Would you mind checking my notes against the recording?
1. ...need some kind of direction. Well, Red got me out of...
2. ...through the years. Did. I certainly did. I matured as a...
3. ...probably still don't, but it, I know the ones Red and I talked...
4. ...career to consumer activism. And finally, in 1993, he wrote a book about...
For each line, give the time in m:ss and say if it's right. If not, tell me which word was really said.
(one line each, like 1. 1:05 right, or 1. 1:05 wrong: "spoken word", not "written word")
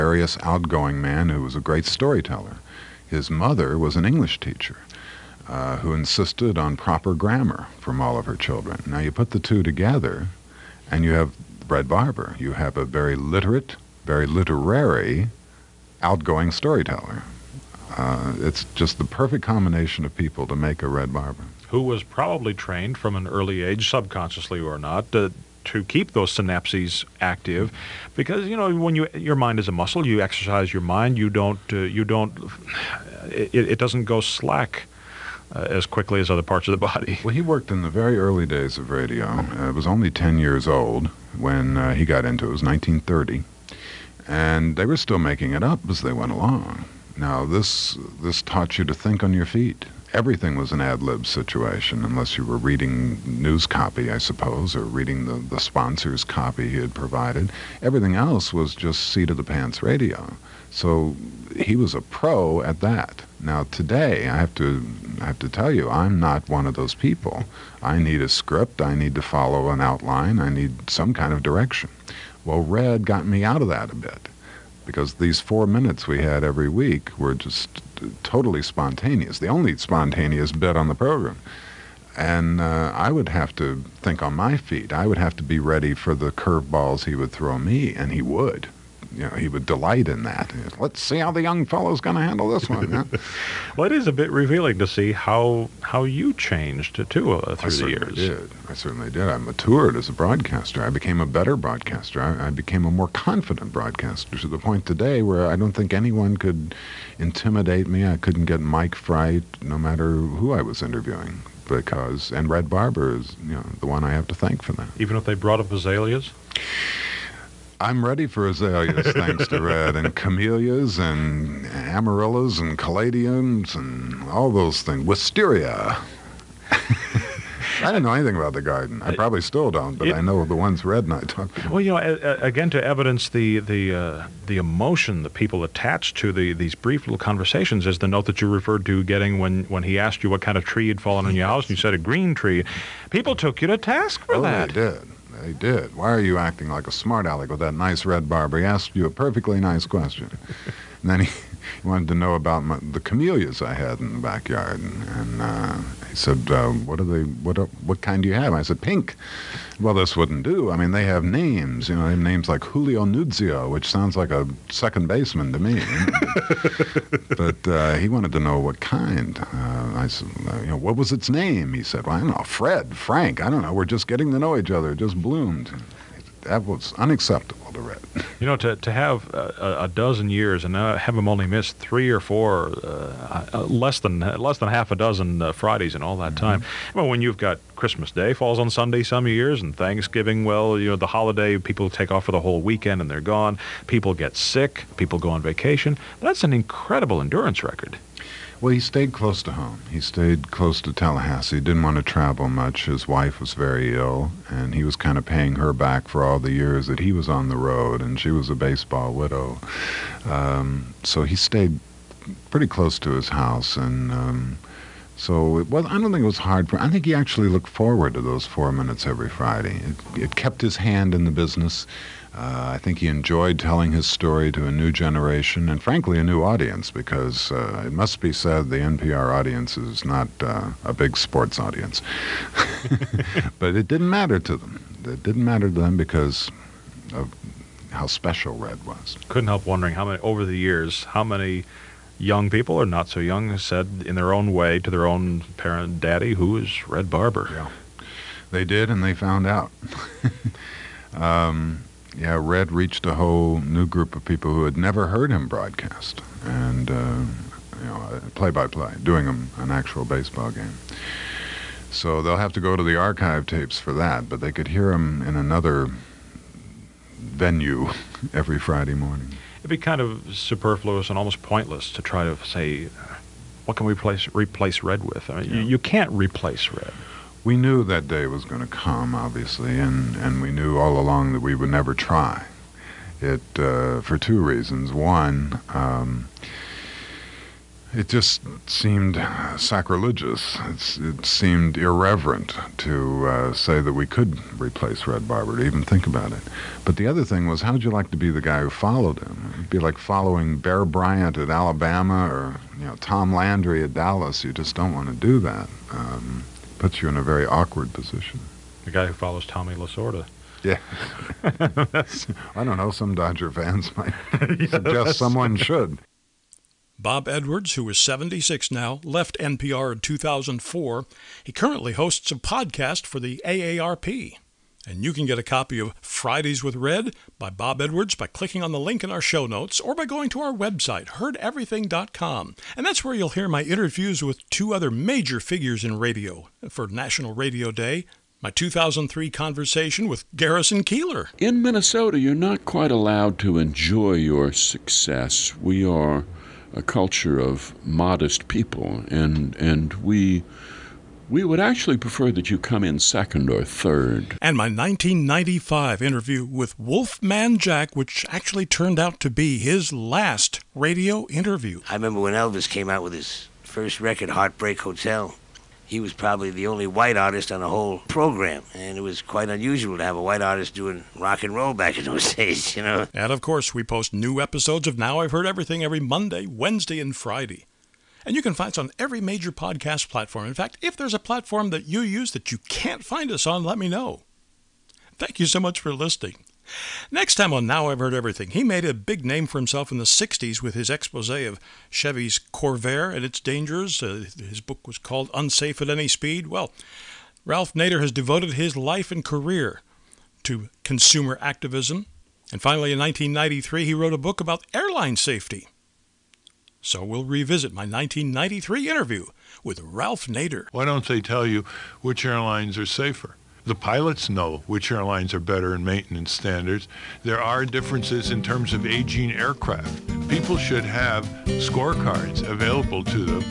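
1. 1:10 right
2. 1:37 right
3. 2:09 right
4. 6:39 right.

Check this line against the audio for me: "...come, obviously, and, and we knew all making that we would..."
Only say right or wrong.
wrong.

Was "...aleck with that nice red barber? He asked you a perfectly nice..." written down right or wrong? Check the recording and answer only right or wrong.
right.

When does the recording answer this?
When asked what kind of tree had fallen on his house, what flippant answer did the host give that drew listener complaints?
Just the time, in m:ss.
2:21.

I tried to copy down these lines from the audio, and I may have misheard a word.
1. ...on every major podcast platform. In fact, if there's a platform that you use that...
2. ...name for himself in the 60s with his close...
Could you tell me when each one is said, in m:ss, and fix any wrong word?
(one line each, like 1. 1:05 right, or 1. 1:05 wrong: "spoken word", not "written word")
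1. 6:18 right
2. 6:29 wrong: "expose", not "close".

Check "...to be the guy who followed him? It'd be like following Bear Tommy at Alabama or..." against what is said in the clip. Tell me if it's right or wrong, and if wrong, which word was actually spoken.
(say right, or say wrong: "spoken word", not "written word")
wrong: "Bryant", not "Tommy".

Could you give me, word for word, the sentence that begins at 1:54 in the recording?
Even if they brought up azaleas.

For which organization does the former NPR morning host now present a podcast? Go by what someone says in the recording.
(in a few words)
AARP.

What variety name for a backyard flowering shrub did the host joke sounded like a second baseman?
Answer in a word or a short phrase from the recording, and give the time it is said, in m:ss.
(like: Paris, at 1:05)
Julio Nuccio, at 2:42.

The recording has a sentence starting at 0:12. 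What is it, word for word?
You have a very literate, very literary, outgoing storyteller.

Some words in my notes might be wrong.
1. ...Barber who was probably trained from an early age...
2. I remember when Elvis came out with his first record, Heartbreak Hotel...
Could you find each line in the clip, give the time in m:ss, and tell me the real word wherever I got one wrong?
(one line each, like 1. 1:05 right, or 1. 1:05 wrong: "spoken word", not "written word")
1. 0:21 right
2. 6:01 right.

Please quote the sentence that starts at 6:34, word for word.
Uh, his book was called Unsafe at Any Speed.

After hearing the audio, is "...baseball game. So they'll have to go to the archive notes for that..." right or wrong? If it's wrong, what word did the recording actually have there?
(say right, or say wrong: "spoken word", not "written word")
wrong: "tapes", not "notes".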